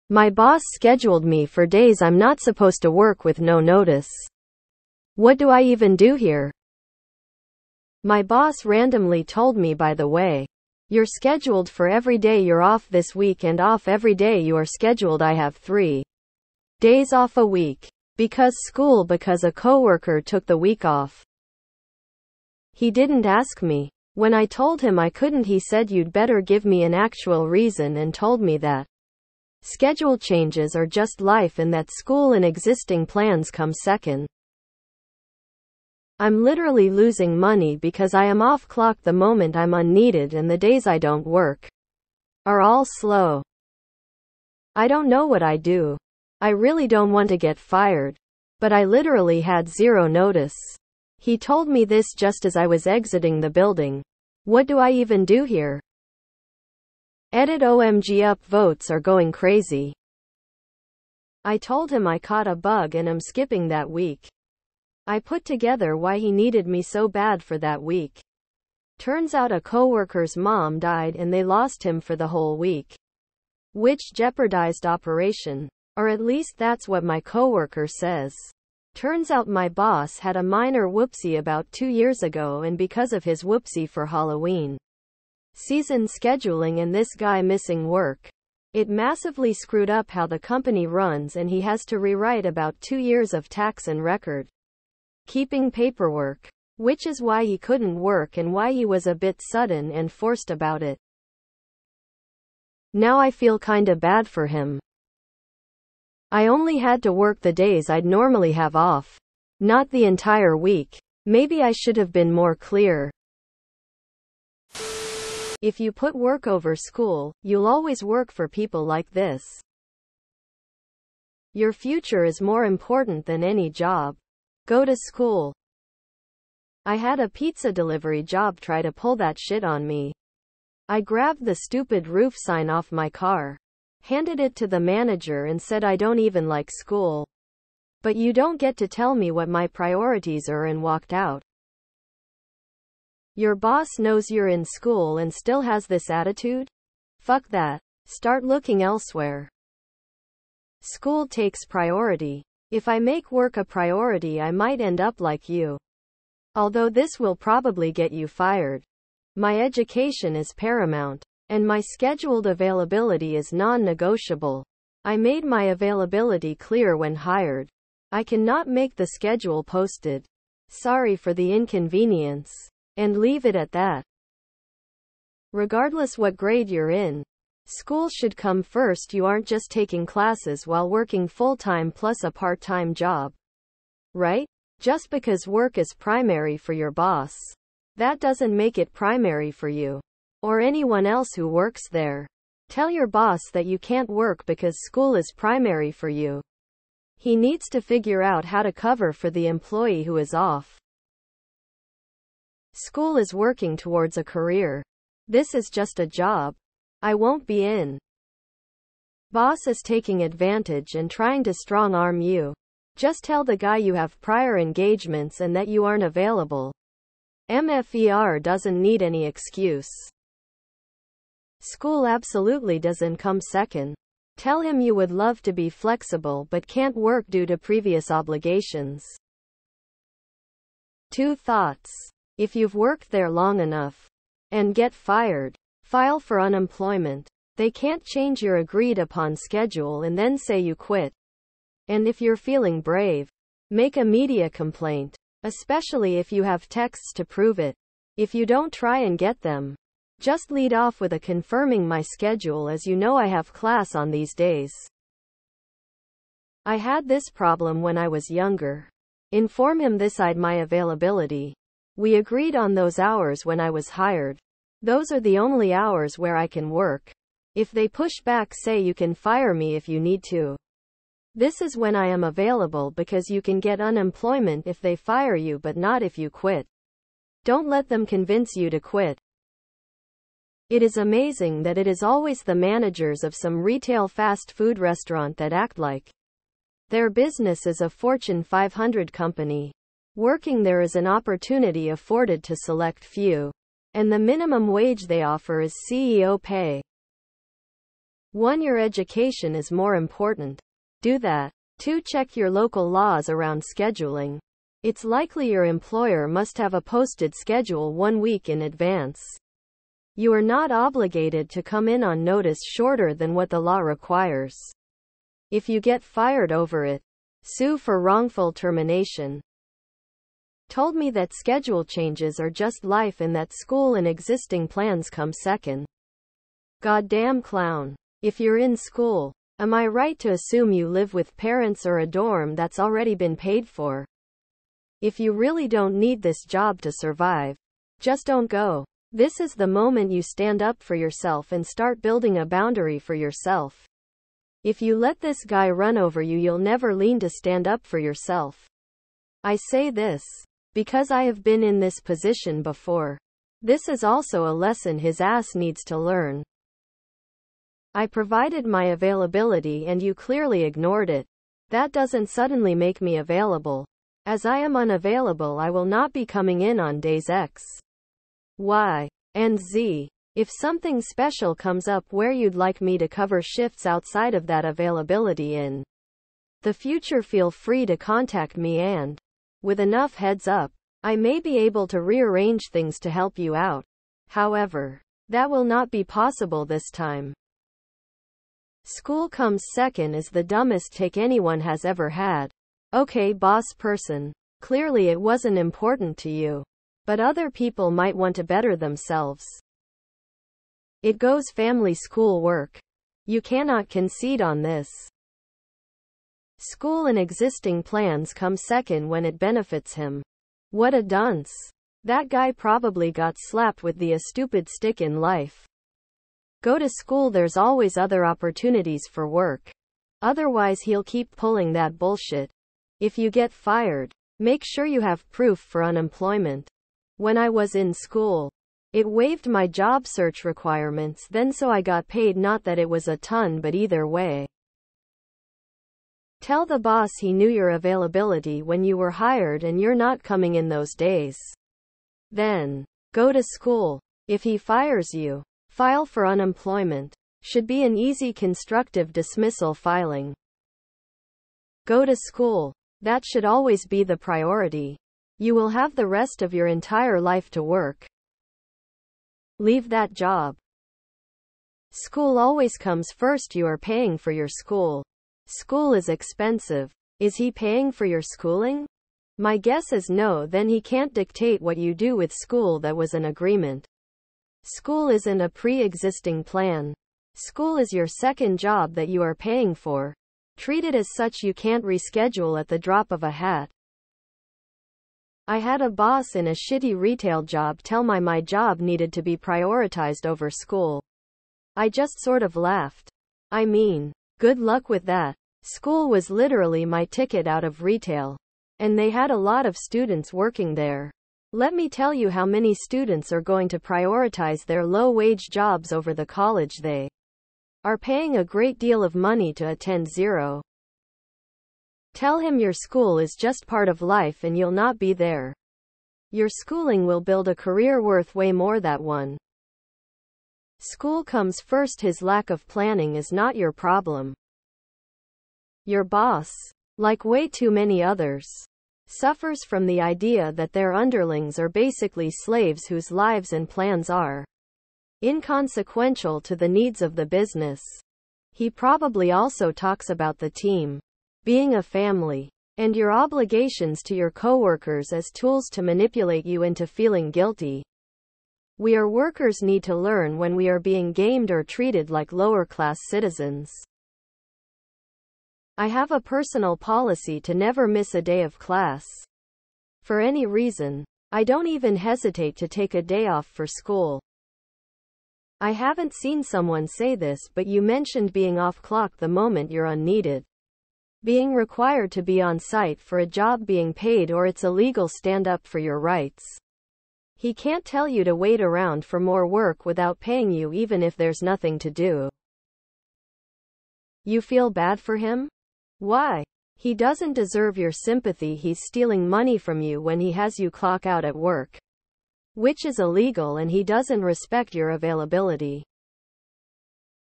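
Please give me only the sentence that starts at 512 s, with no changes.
Tell him your school is just part of life and you'll not be there.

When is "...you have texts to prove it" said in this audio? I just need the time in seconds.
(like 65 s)
246 s.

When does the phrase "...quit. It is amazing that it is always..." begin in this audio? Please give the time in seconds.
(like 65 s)
278 s.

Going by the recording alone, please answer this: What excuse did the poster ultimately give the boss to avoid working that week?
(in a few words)
Caught a bug.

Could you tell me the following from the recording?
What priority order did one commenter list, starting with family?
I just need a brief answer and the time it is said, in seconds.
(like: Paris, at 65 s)
Family, school, work, at 401 s.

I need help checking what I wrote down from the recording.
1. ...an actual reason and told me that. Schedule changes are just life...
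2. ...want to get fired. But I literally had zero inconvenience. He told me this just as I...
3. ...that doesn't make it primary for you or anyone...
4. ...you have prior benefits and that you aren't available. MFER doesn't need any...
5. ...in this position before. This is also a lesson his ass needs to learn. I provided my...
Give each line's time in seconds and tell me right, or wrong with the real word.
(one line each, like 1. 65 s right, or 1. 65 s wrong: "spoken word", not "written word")
1. 26 s right
2. 47 s wrong: "notice", not "inconvenience"
3. 187 s right
4. 213 s wrong: "engagements", not "benefits"
5. 351 s right.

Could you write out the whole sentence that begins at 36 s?
I'm literally losing money because I am off clock the moment I'm unneeded and the days I don't work are all slow.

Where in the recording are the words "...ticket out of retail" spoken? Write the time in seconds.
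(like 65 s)
497 s.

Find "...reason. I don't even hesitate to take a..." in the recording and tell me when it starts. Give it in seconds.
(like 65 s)
560 s.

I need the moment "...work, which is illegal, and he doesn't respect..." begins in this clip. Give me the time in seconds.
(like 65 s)
591 s.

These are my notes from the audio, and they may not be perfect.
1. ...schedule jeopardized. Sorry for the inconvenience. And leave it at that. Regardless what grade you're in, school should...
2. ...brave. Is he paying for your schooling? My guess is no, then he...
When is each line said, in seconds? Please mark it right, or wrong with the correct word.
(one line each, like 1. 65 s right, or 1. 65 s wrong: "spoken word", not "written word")
1. 169 s wrong: "posted", not "jeopardized"
2. 466 s wrong: "expensive", not "brave".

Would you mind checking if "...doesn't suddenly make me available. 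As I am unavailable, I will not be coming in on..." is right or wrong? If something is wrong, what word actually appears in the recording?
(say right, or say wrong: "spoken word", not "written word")
right.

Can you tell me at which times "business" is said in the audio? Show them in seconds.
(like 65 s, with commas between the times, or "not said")
287 s, 537 s.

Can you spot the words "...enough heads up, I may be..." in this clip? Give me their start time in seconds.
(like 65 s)
379 s.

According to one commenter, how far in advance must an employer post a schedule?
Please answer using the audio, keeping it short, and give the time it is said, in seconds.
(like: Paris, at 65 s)
One week, at 307 s.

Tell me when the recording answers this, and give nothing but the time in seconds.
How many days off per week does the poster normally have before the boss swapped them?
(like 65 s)
15 s.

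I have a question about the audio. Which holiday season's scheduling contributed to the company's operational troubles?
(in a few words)
Halloween.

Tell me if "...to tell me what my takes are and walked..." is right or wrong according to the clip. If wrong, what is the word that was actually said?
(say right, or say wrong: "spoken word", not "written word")
wrong: "priorities", not "takes".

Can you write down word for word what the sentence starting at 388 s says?
School comes second is the dumbest take anyone has ever had.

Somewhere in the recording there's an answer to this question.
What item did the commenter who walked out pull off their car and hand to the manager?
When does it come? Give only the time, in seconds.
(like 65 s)
132 s.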